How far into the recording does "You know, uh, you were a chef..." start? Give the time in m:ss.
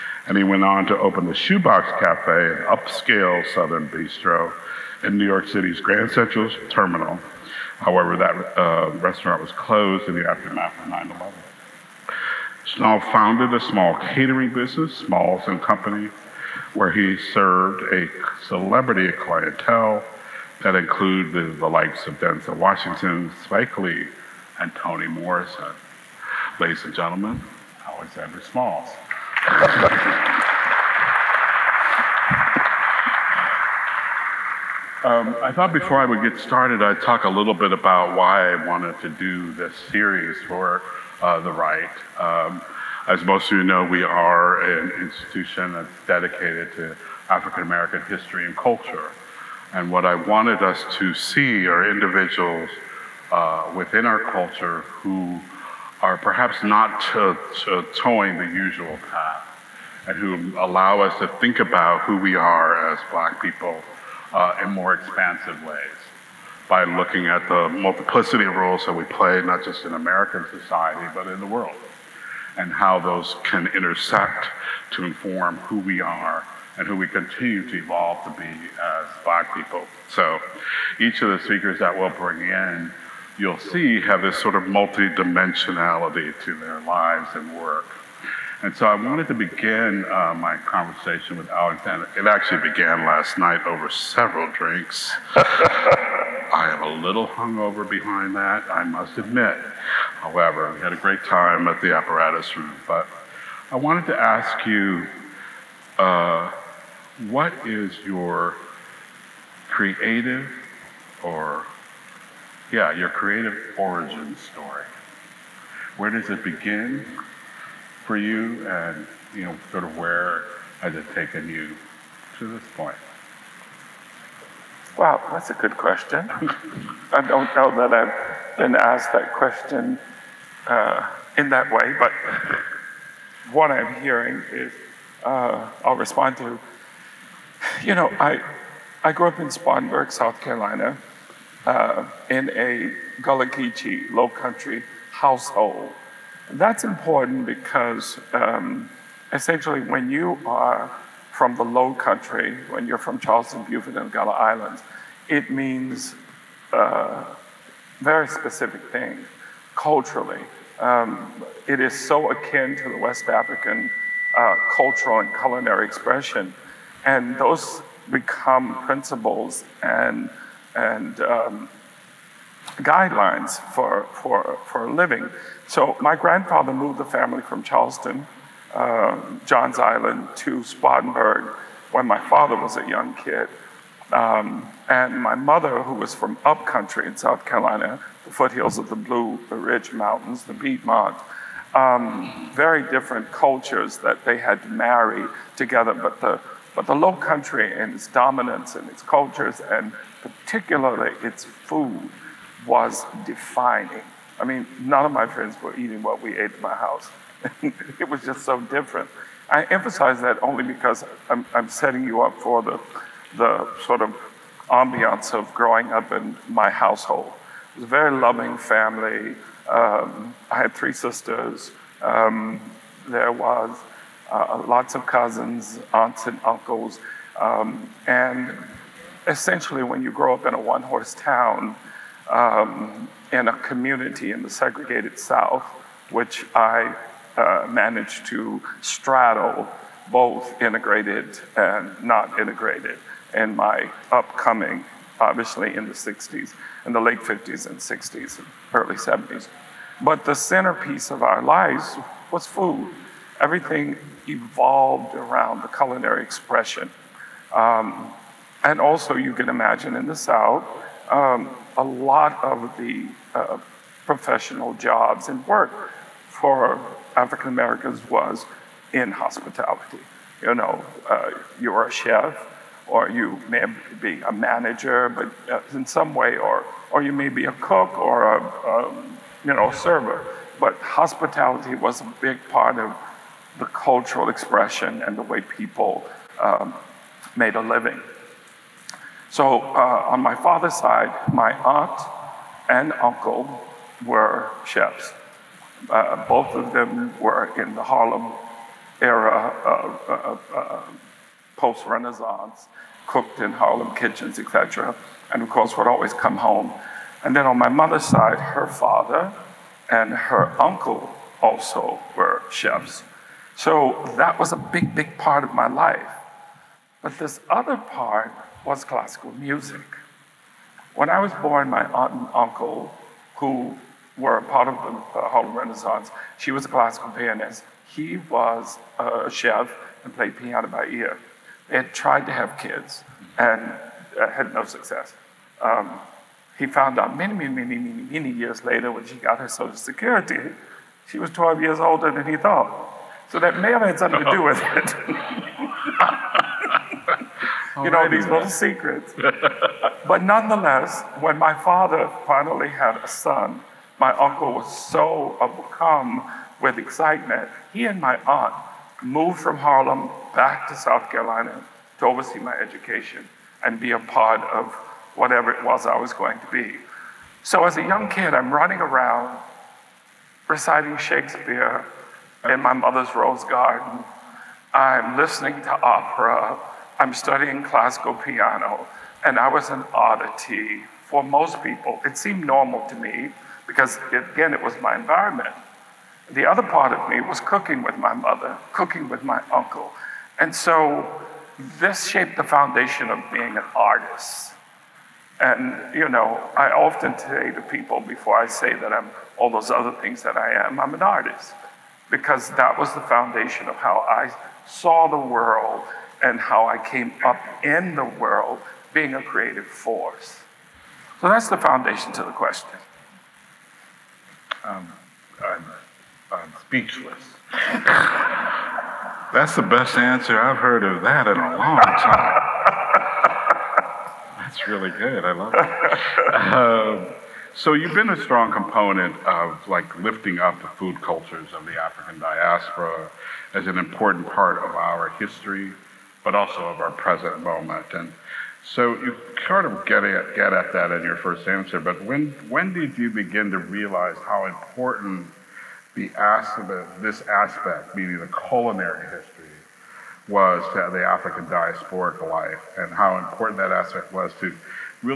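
4:30.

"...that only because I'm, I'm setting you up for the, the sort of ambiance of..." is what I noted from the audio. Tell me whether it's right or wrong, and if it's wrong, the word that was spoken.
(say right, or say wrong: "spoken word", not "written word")
right.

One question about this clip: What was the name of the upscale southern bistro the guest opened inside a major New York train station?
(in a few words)
Shoebox Cafe.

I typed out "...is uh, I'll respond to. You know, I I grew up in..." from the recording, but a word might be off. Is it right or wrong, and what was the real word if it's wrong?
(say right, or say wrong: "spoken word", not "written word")
right.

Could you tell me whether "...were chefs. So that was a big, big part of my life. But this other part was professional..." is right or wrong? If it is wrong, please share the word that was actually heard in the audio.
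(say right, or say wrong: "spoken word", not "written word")
wrong: "classical", not "professional".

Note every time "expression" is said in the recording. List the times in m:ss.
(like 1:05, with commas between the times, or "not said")
2:45, 4:16, 4:44.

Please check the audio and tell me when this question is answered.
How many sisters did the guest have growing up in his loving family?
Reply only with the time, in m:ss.
3:40.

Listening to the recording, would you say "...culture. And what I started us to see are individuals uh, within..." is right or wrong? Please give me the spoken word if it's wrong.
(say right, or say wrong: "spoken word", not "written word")
wrong: "wanted", not "started".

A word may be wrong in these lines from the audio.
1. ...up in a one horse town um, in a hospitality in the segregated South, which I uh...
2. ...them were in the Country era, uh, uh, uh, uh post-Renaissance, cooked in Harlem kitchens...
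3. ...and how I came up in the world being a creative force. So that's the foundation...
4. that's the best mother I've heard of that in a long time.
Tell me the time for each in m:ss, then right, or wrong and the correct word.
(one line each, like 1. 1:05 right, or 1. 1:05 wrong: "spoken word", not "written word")
1. 3:50 wrong: "community", not "hospitality"
2. 4:56 wrong: "Harlem", not "Country"
3. 6:46 right
4. 6:59 wrong: "answer", not "mother".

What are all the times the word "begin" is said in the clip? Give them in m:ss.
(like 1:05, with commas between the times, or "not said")
1:29, 1:56, 7:23.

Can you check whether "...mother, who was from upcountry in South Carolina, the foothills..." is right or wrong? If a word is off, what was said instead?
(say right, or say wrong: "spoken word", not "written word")
right.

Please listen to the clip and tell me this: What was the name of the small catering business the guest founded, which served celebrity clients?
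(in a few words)
Smalls and Company.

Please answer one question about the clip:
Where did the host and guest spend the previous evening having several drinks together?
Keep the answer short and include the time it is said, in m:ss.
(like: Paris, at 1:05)
the apparatus room, at 1:41.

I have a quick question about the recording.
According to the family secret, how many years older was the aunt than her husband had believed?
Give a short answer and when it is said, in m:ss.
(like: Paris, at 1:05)
12, at 5:41.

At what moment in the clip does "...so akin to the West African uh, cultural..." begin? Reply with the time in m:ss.
2:41.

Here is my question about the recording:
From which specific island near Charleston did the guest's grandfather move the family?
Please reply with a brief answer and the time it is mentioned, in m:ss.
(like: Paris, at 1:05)
Johns Island, at 2:59.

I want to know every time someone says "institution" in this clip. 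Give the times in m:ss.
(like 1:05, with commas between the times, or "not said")
0:45.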